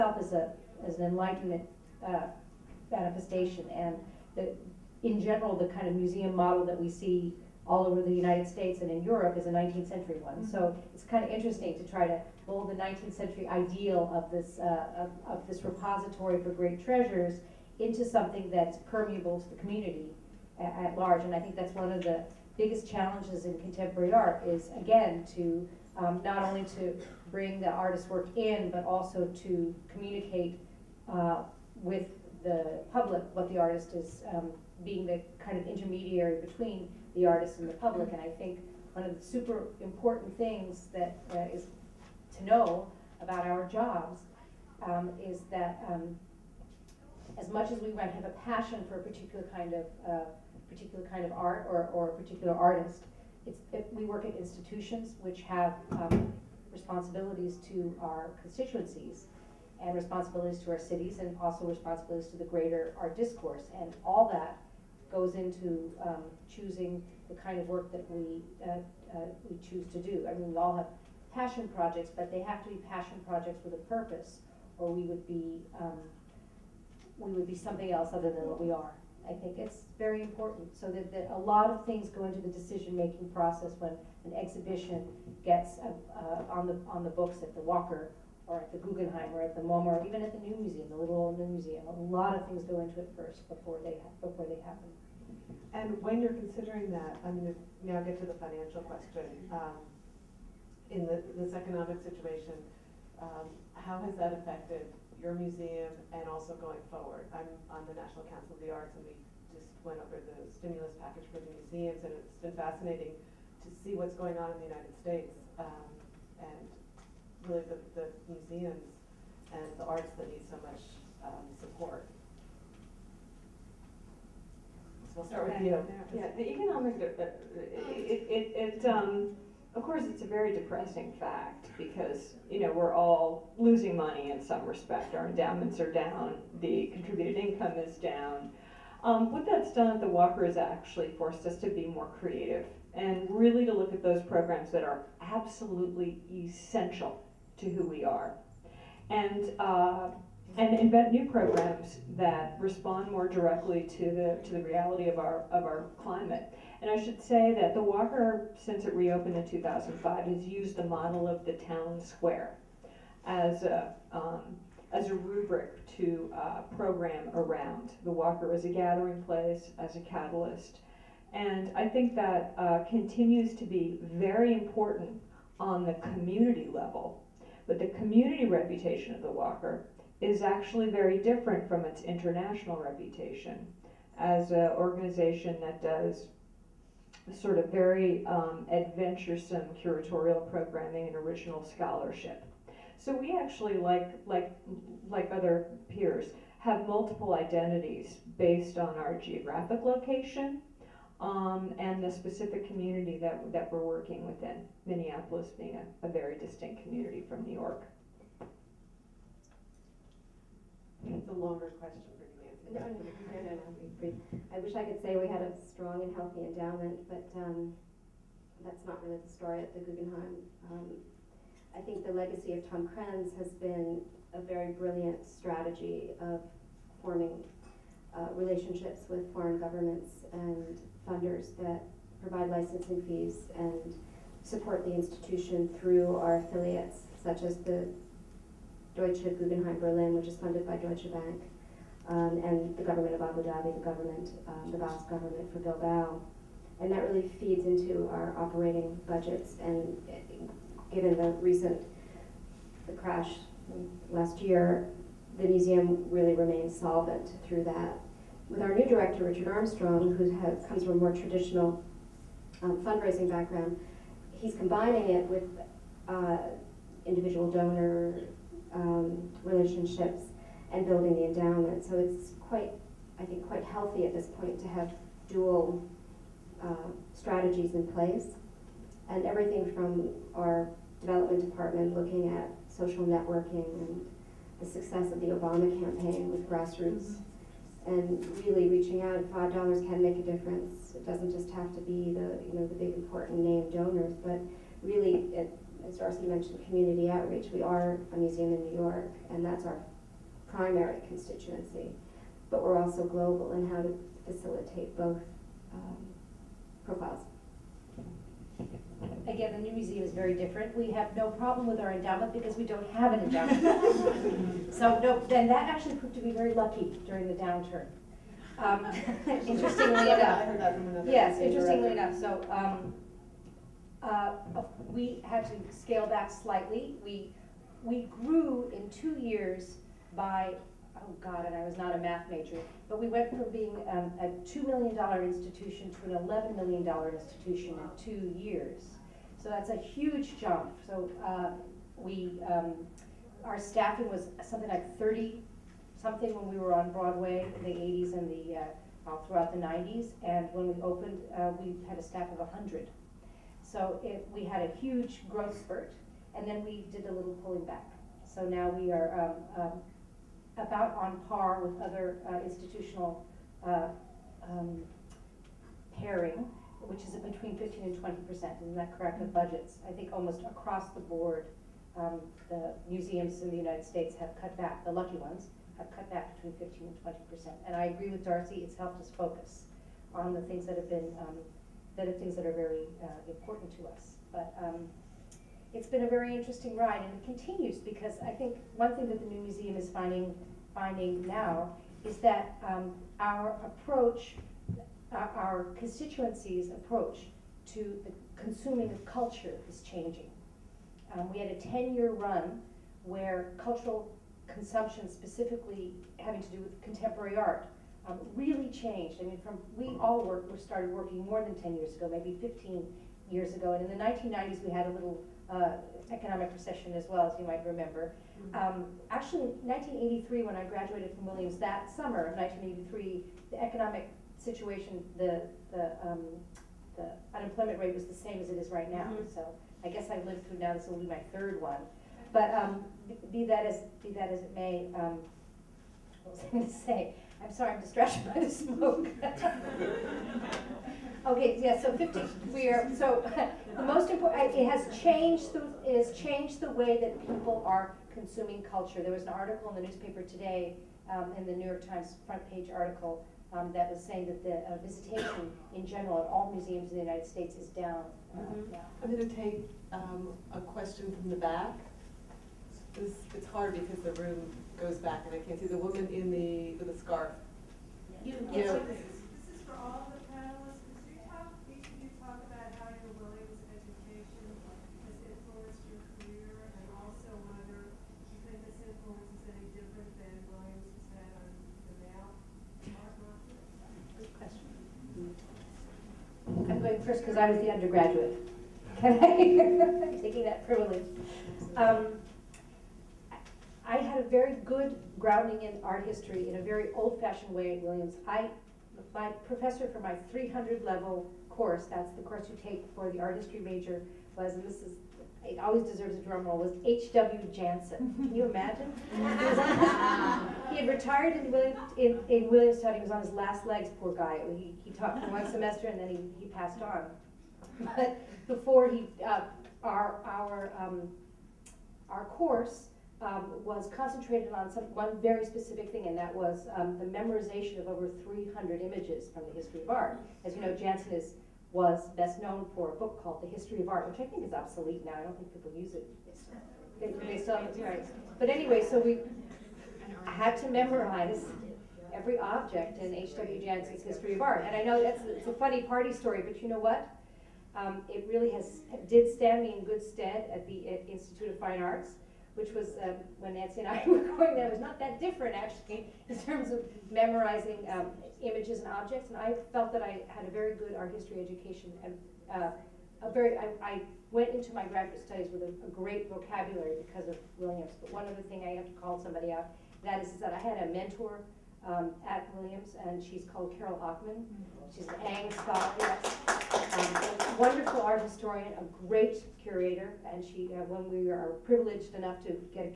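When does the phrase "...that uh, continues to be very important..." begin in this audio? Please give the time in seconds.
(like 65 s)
172 s.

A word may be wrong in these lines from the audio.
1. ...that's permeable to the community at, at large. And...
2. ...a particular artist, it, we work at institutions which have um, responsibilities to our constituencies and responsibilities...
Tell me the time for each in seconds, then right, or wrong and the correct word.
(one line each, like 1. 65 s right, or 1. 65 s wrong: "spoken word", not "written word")
1. 18 s right
2. 52 s right.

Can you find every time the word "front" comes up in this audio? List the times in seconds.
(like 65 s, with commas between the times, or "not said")
452 s.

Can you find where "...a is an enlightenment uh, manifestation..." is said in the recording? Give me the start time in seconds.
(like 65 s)
0 s.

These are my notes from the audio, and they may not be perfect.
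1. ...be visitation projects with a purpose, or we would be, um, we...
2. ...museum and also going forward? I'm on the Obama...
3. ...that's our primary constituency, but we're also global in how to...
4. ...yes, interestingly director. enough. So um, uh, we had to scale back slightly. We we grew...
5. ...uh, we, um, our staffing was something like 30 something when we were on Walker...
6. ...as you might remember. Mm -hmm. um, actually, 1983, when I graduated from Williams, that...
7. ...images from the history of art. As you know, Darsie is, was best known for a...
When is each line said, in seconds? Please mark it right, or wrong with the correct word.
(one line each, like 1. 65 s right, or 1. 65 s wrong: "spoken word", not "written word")
1. 72 s wrong: "passion", not "visitation"
2. 105 s wrong: "National", not "Obama"
3. 299 s right
4. 321 s right
5. 341 s wrong: "Broadway", not "Walker"
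6. 417 s right
7. 528 s wrong: "Janson", not "Darsie".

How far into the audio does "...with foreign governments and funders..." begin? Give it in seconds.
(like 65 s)
229 s.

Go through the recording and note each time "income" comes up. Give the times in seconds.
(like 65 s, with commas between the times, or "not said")
137 s.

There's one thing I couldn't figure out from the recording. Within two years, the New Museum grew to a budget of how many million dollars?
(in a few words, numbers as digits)
$11 million.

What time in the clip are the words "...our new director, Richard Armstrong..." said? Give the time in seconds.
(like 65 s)
258 s.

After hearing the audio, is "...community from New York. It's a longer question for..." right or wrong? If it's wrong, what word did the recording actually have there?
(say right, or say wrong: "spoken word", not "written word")
right.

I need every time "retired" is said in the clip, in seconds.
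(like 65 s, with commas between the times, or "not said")
510 s.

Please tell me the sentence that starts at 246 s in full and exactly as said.
And that really feeds into our operating budgets.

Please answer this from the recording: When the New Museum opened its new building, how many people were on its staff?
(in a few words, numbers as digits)
100.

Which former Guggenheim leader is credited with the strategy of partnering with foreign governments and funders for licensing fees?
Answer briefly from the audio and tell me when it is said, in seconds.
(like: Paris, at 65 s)
Tom Krens, at 222 s.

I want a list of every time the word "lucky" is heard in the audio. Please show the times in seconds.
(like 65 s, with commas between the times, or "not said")
316 s, 374 s.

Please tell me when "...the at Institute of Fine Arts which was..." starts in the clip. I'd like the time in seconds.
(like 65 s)
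550 s.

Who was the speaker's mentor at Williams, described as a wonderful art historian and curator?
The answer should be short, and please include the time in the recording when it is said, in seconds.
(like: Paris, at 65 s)
Carol Ockman, at 573 s.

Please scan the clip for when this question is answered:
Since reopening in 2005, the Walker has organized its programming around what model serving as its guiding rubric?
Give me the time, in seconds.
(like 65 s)
161 s.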